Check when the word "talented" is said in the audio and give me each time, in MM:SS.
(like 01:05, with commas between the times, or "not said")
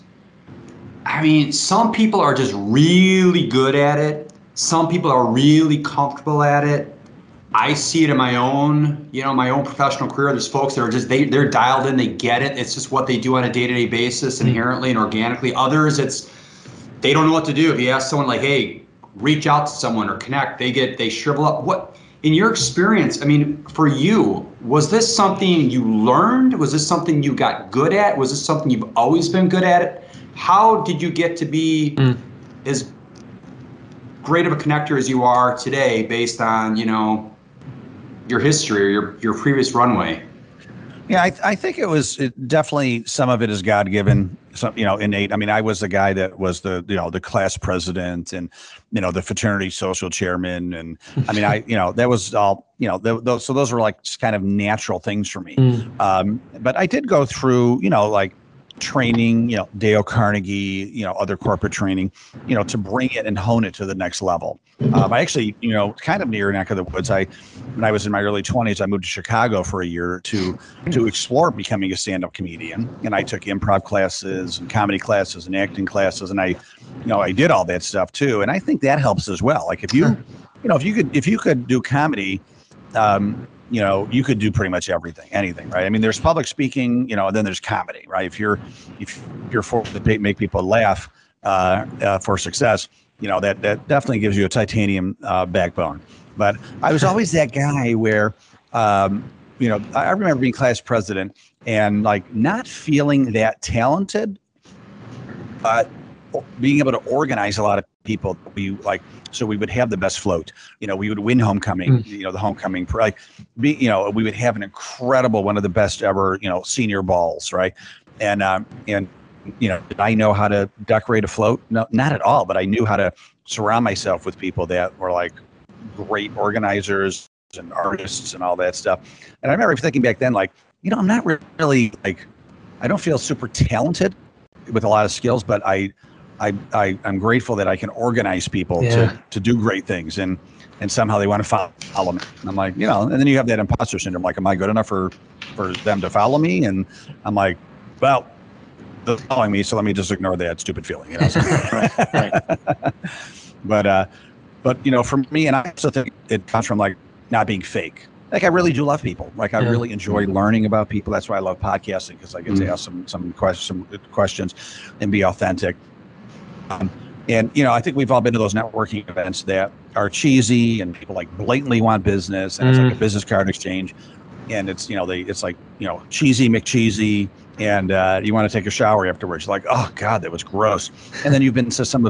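01:43, 02:13.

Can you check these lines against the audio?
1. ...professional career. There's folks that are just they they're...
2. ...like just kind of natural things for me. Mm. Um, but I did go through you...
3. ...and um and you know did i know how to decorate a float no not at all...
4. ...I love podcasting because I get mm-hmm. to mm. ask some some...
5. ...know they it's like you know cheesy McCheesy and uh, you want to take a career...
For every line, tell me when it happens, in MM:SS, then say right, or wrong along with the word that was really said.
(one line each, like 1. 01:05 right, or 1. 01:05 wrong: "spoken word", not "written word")
1. 00:09 right
2. 00:53 right
3. 01:58 right
4. 02:41 right
5. 02:54 wrong: "shower", not "career".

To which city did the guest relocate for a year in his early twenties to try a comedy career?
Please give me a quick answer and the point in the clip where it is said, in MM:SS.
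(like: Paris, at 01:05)
Chicago, at 01:09.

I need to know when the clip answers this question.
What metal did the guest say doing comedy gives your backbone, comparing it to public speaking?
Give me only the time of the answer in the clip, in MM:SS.
01:34.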